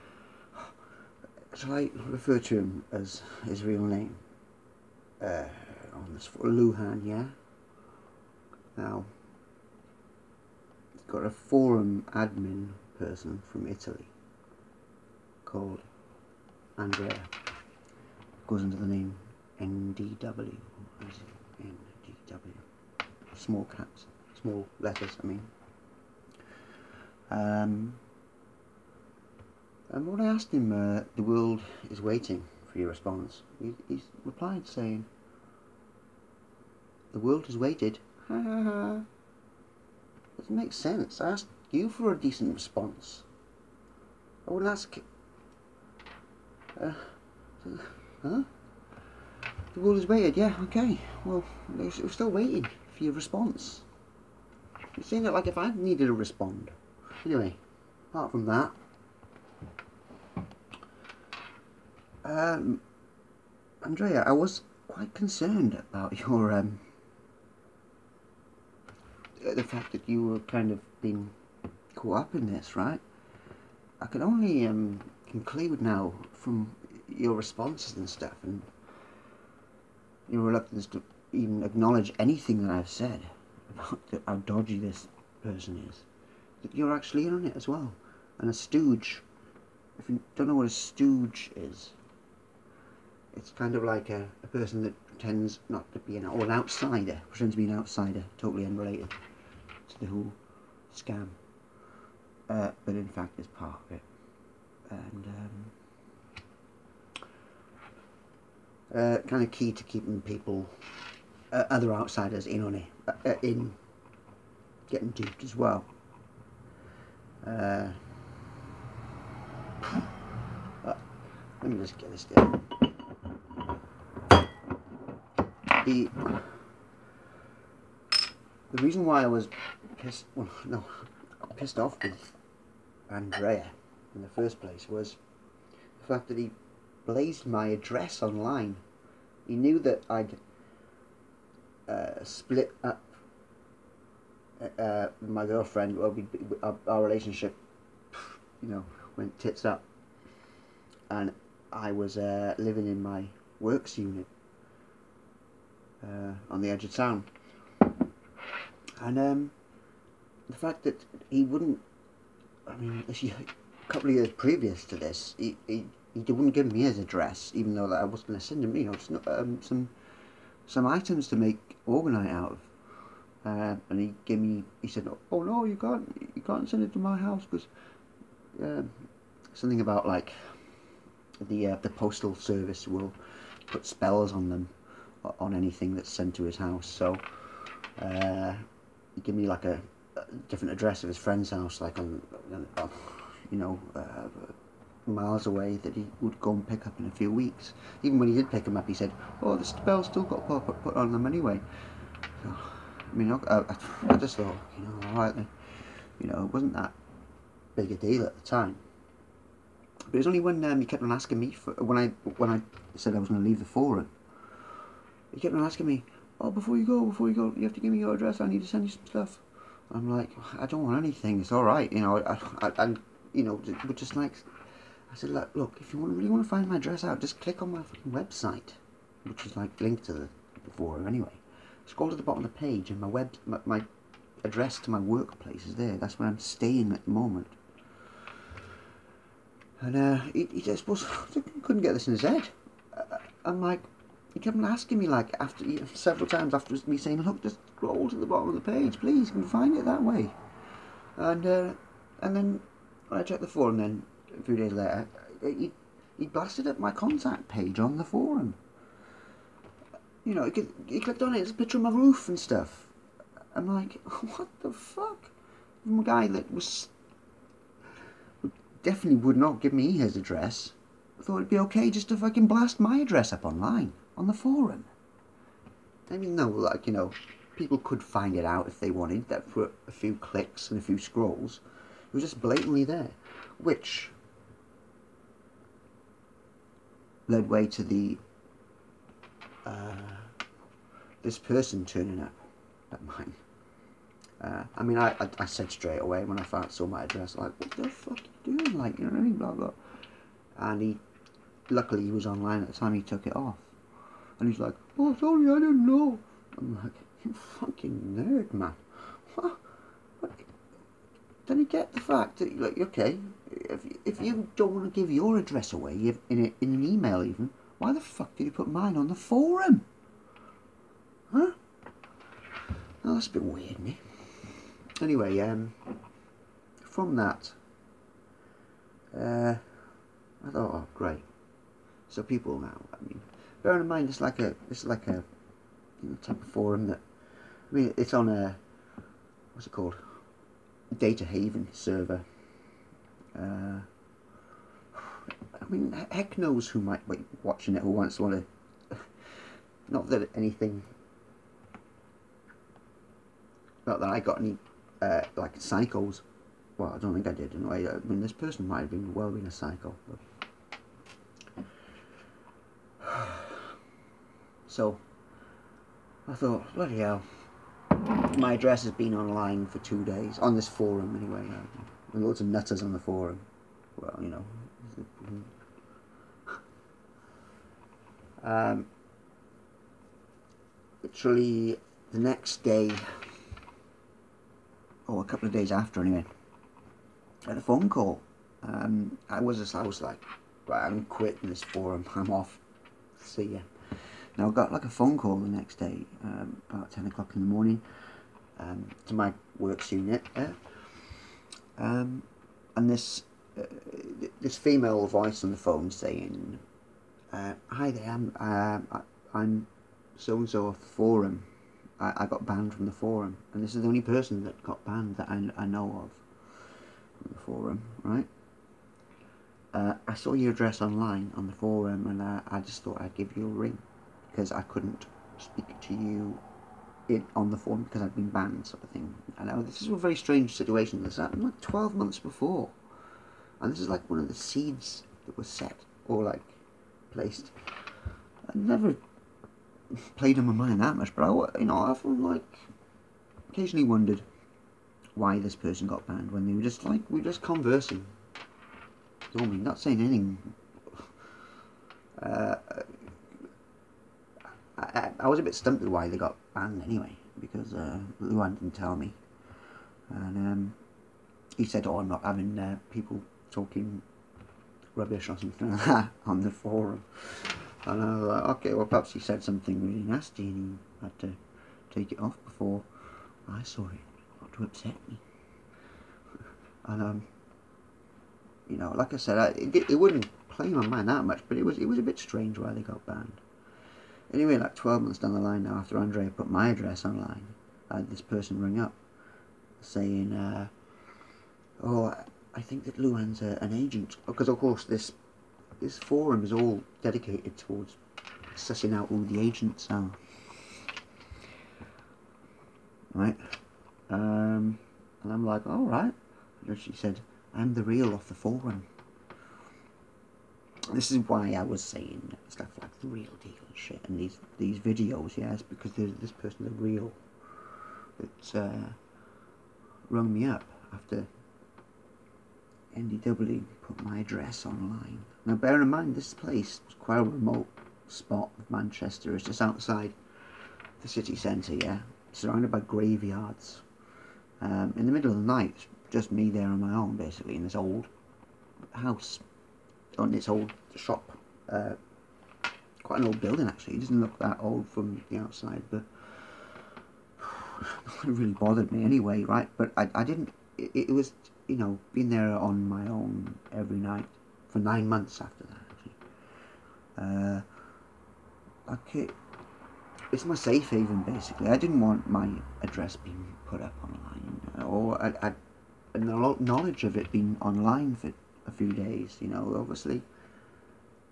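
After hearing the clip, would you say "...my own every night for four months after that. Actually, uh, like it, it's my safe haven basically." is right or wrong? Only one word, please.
wrong.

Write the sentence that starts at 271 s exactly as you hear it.
I thought it'd be okay just to fucking blast my address up online, on the forum.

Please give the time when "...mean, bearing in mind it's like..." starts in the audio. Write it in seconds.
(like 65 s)
333 s.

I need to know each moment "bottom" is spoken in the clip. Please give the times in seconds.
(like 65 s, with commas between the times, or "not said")
232 s, 248 s.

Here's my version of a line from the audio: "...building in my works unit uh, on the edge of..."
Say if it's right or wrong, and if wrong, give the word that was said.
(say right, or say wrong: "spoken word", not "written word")
wrong: "living", not "building".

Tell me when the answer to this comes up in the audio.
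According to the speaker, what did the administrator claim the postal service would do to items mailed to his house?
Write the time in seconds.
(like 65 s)
183 s.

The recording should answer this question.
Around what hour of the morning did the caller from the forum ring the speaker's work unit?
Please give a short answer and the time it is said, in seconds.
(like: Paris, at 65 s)
10 o'clock, at 396 s.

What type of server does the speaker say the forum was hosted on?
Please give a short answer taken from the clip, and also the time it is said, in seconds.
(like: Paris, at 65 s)
data haven server, at 340 s.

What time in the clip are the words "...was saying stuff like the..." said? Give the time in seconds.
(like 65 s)
511 s.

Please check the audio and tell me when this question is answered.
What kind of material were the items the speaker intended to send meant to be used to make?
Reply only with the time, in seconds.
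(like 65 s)
171 s.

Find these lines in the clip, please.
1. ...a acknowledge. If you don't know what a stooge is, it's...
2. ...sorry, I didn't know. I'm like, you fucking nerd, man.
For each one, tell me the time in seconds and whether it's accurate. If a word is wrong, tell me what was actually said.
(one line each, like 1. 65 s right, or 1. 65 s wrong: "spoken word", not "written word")
1. 88 s wrong: "stooge", not "acknowledge"
2. 305 s right.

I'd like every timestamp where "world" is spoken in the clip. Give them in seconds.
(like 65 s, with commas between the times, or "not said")
31 s, 37 s, 49 s.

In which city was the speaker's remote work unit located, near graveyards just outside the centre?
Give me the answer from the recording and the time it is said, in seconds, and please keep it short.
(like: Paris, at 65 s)
Manchester, at 528 s.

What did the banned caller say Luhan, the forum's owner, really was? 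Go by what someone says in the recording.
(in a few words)
an agent.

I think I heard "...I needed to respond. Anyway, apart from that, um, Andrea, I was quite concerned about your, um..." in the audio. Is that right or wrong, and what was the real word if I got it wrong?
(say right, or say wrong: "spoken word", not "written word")
right.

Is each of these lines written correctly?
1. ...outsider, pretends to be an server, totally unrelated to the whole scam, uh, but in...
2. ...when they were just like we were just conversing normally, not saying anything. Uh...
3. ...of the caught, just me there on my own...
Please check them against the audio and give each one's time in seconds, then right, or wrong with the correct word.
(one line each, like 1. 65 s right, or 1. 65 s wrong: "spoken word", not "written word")
1. 96 s wrong: "outsider", not "server"
2. 446 s right
3. 535 s wrong: "night", not "caught".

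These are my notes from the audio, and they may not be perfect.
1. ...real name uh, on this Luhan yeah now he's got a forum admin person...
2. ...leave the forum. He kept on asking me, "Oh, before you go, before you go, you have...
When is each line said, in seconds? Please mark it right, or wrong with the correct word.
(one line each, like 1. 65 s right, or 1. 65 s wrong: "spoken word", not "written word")
1. 3 s right
2. 213 s right.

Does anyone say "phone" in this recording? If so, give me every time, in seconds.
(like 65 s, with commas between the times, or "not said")
387 s, 394 s, 405 s, 427 s.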